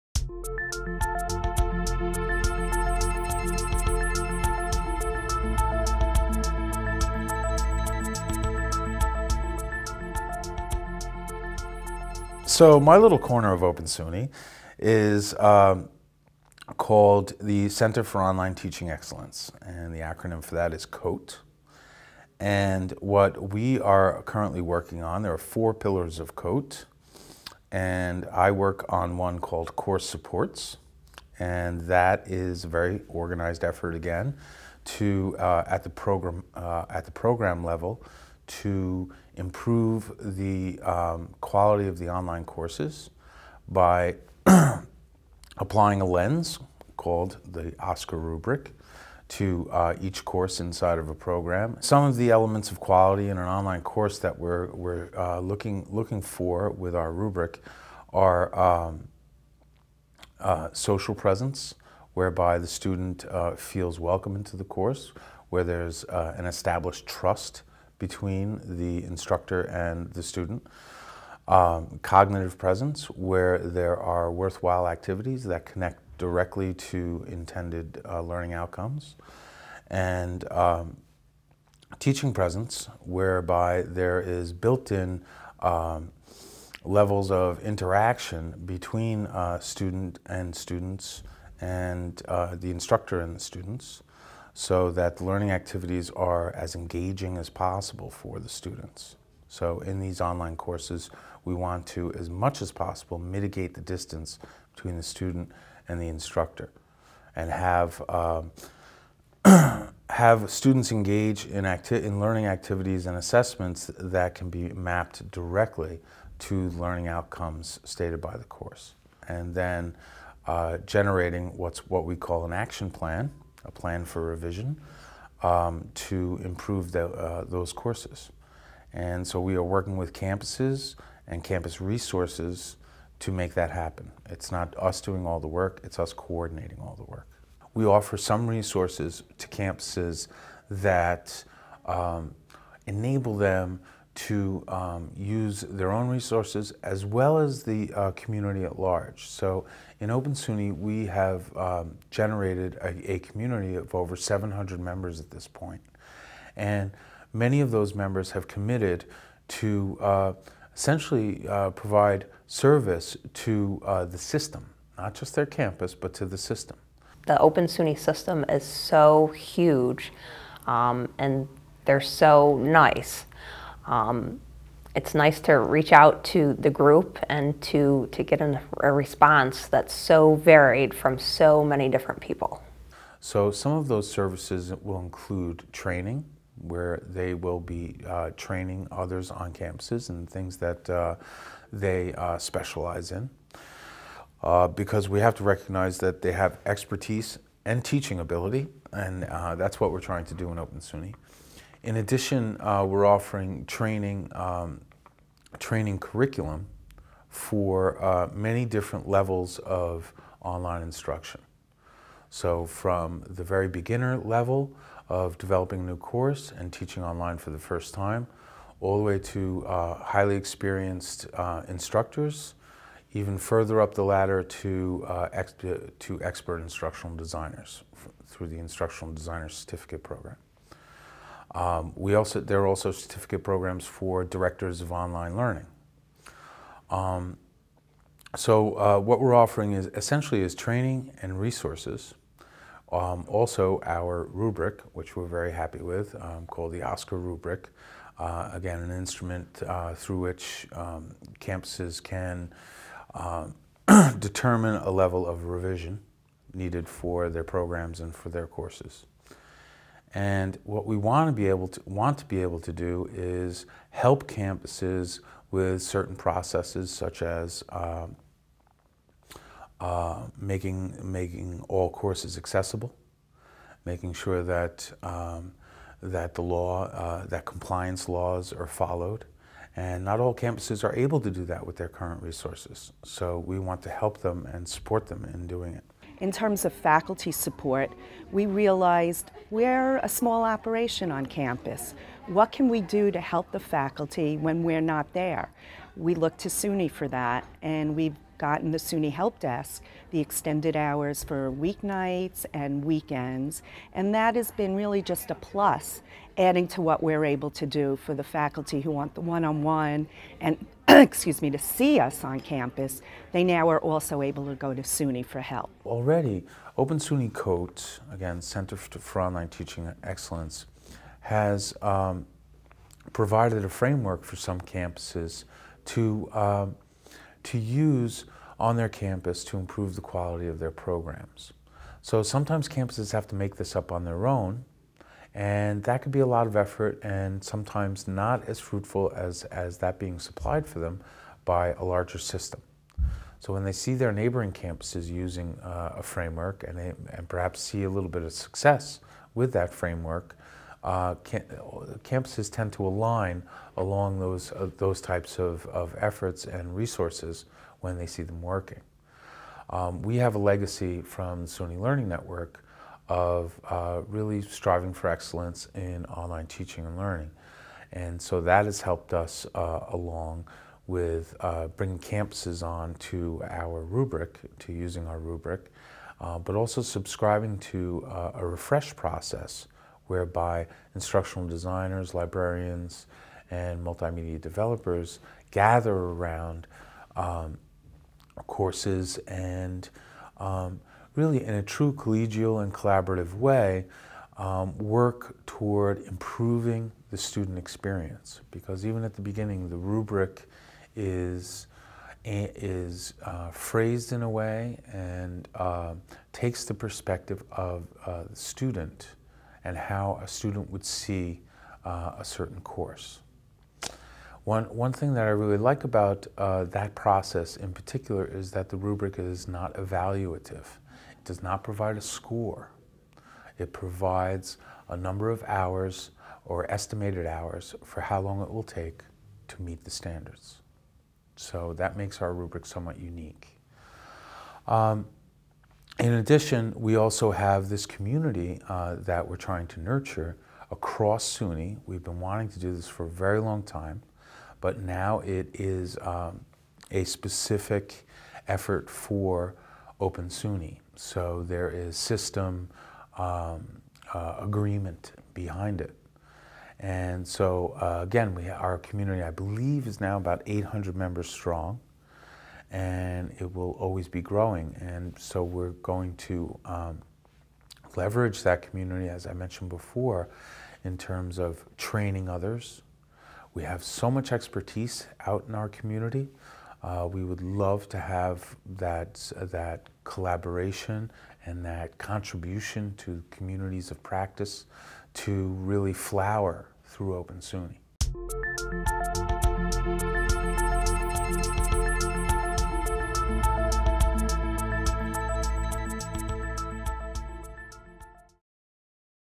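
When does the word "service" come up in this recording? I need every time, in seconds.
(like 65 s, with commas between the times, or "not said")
162 s, 184 s.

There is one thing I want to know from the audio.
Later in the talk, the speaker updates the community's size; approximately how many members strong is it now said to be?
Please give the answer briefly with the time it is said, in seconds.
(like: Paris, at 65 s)
800, at 460 s.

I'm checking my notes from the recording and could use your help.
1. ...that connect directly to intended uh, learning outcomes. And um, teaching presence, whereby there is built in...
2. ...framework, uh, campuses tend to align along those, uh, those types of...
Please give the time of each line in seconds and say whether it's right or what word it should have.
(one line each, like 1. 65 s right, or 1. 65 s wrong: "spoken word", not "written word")
1. 75 s right
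2. 349 s right.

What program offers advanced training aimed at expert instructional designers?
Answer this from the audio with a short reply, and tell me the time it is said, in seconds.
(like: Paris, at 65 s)
Instructional Designer Certificate Program, at 228 s.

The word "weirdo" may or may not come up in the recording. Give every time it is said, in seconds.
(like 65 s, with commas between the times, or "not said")
not said.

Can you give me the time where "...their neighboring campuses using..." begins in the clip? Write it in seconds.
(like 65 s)
343 s.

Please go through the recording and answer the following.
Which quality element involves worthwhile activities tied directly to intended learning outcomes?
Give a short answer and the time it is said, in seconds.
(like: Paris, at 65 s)
cognitive presence, at 72 s.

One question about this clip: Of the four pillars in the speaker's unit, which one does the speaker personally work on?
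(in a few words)
Course Supports.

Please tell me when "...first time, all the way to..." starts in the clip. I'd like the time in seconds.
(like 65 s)
217 s.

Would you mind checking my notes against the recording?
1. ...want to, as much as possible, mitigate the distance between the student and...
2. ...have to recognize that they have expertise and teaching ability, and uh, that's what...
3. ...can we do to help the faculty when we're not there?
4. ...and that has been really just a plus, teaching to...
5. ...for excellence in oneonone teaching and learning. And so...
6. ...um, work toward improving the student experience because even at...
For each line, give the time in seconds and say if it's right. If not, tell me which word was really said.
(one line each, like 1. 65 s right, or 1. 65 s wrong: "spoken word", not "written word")
1. 101 s right
2. 195 s right
3. 292 s right
4. 303 s wrong: "adding", not "teaching"
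5. 364 s wrong: "online", not "oneonone"
6. 394 s right.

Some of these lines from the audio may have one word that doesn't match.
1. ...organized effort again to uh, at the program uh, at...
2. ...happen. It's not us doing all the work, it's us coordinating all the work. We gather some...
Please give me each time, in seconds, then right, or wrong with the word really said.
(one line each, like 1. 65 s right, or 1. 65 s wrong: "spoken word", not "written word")
1. 33 s right
2. 133 s wrong: "offer", not "gather".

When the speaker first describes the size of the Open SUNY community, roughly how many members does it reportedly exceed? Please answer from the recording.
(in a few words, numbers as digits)
700.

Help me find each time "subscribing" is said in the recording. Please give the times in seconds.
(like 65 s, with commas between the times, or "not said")
376 s.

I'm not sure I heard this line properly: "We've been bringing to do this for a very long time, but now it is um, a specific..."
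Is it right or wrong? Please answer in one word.
wrong.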